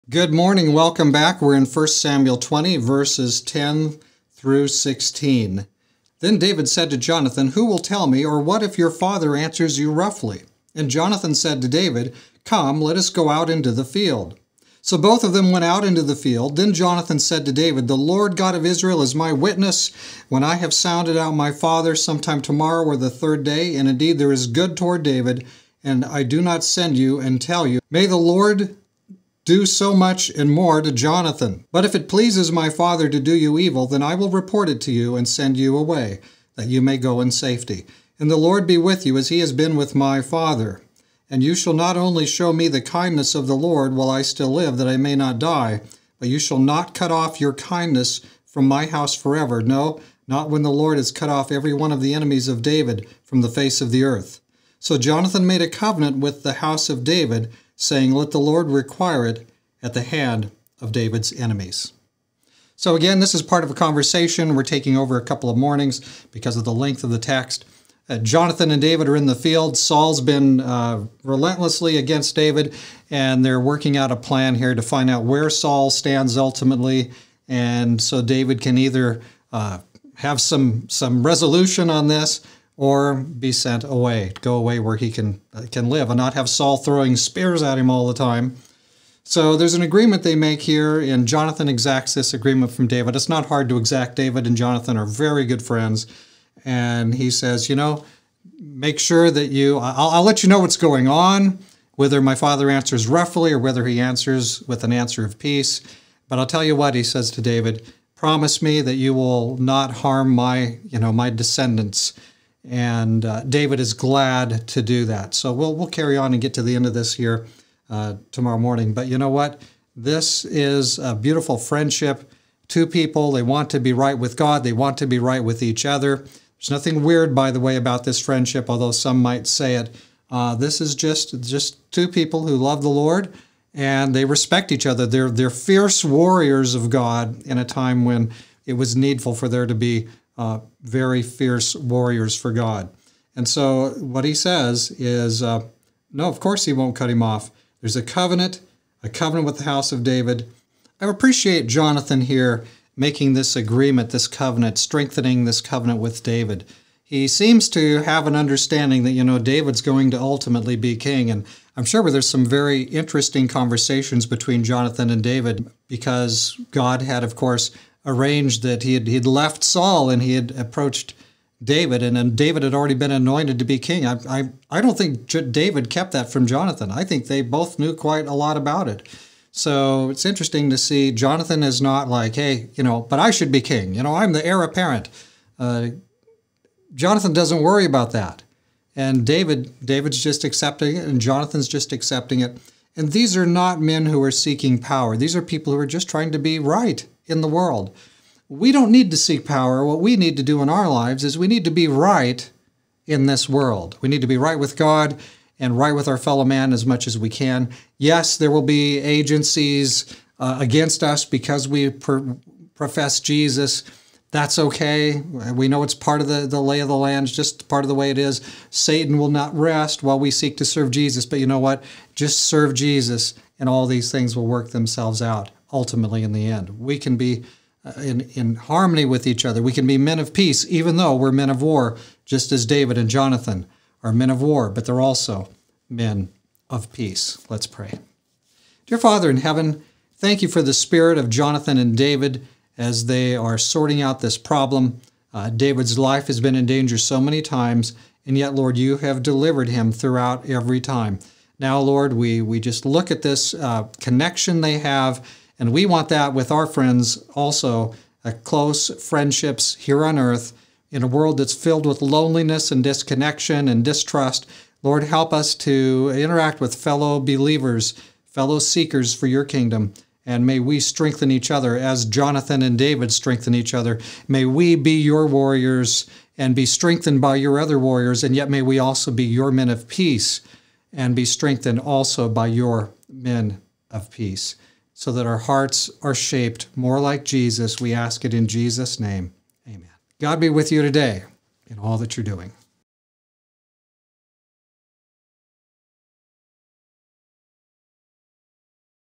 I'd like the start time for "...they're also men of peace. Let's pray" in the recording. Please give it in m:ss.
3:54.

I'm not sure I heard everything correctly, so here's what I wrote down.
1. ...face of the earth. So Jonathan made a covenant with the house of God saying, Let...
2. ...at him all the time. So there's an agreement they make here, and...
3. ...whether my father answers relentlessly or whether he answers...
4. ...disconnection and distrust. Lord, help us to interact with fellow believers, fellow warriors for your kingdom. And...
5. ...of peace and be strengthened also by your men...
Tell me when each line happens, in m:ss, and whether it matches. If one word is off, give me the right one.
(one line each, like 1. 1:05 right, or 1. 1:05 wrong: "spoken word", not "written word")
1. 0:53 wrong: "David", not "God"
2. 1:27 right
3. 1:41 wrong: "roughly", not "relentlessly"
4. 4:22 wrong: "seekers", not "warriors"
5. 4:39 right.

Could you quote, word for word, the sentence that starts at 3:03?
You know, I'm the heir apparent.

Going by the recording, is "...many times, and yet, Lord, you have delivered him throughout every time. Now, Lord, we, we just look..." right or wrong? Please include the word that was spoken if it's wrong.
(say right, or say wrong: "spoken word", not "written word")
right.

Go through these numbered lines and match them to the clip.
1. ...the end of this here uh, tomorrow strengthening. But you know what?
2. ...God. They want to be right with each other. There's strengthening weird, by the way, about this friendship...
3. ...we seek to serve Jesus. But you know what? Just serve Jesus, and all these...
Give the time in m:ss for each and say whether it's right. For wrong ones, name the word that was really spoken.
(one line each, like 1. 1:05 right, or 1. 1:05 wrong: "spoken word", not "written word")
1. 1:56 wrong: "morning", not "strengthening"
2. 2:04 wrong: "nothing", not "strengthening"
3. 3:40 right.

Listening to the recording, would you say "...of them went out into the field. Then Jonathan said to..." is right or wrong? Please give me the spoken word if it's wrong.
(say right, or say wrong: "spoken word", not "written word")
right.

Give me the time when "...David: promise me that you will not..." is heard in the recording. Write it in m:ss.
1:47.